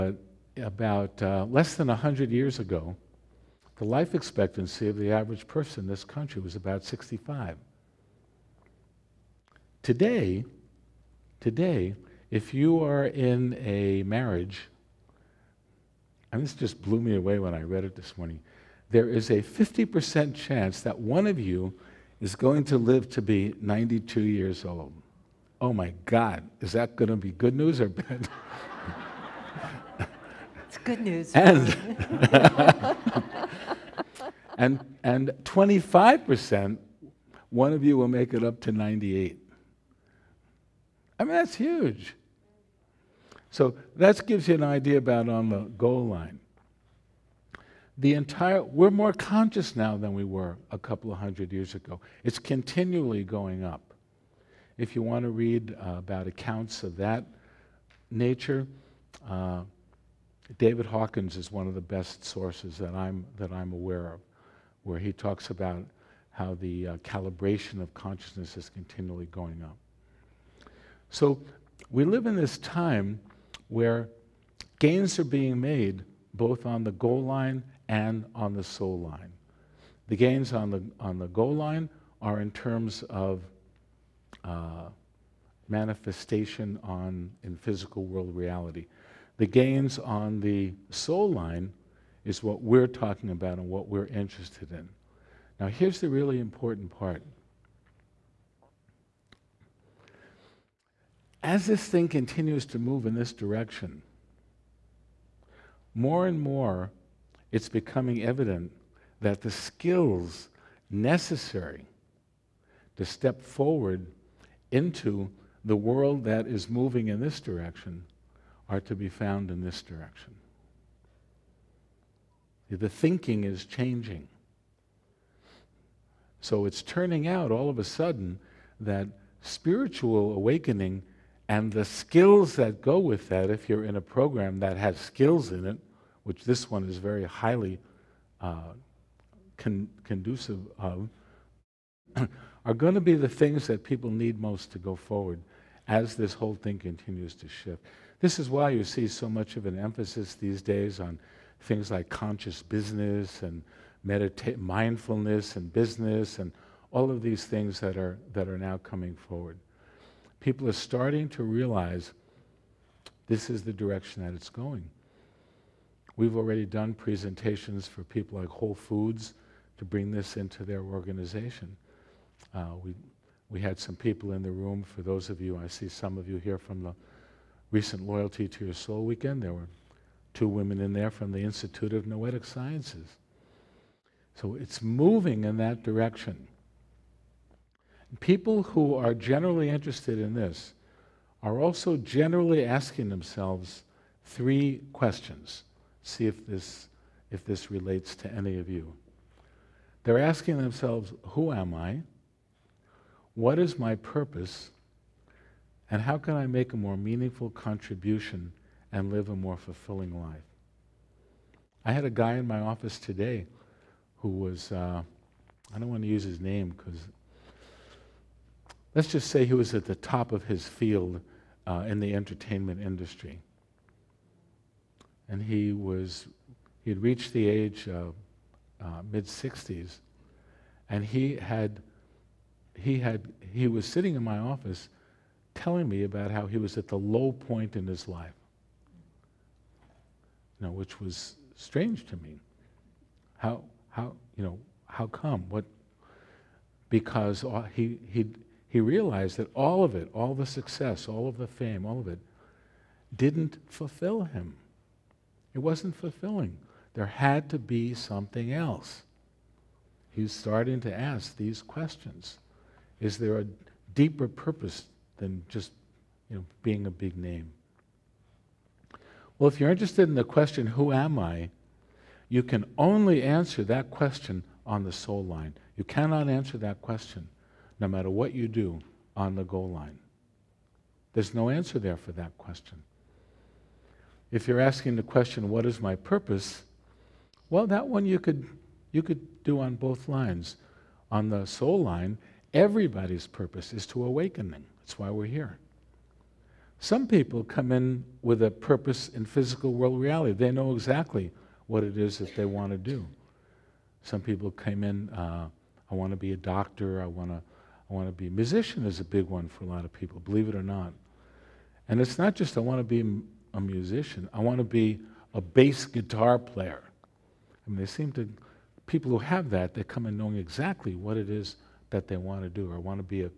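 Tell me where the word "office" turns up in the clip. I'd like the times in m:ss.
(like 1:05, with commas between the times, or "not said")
3:32, 3:54.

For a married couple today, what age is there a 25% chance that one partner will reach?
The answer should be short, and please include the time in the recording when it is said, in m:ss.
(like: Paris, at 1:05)
98, at 0:38.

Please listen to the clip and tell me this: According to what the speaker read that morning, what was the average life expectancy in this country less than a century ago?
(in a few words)
65.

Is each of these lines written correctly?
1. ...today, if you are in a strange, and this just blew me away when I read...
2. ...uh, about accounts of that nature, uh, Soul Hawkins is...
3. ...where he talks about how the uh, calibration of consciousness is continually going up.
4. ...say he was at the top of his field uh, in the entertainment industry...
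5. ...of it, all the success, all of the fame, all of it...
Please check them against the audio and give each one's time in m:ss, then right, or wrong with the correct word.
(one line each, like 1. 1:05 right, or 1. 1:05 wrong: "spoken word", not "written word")
1. 0:11 wrong: "marriage", not "strange"
2. 0:55 wrong: "David", not "Soul"
3. 1:04 right
4. 3:39 right
5. 4:09 right.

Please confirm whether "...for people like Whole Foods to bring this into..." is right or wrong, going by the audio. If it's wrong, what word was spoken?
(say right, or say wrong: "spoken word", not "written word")
right.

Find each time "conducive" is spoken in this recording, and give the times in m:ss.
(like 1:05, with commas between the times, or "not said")
2:20.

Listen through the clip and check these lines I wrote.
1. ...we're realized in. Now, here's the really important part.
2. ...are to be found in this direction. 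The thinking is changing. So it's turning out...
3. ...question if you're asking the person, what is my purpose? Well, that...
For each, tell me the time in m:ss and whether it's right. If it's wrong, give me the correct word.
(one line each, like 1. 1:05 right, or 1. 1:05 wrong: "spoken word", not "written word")
1. 1:33 wrong: "interested", not "realized"
2. 1:58 right
3. 4:42 wrong: "question", not "person".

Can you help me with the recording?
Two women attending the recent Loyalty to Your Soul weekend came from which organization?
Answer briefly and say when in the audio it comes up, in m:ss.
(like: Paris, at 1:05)
Institute of Noetic Sciences, at 3:01.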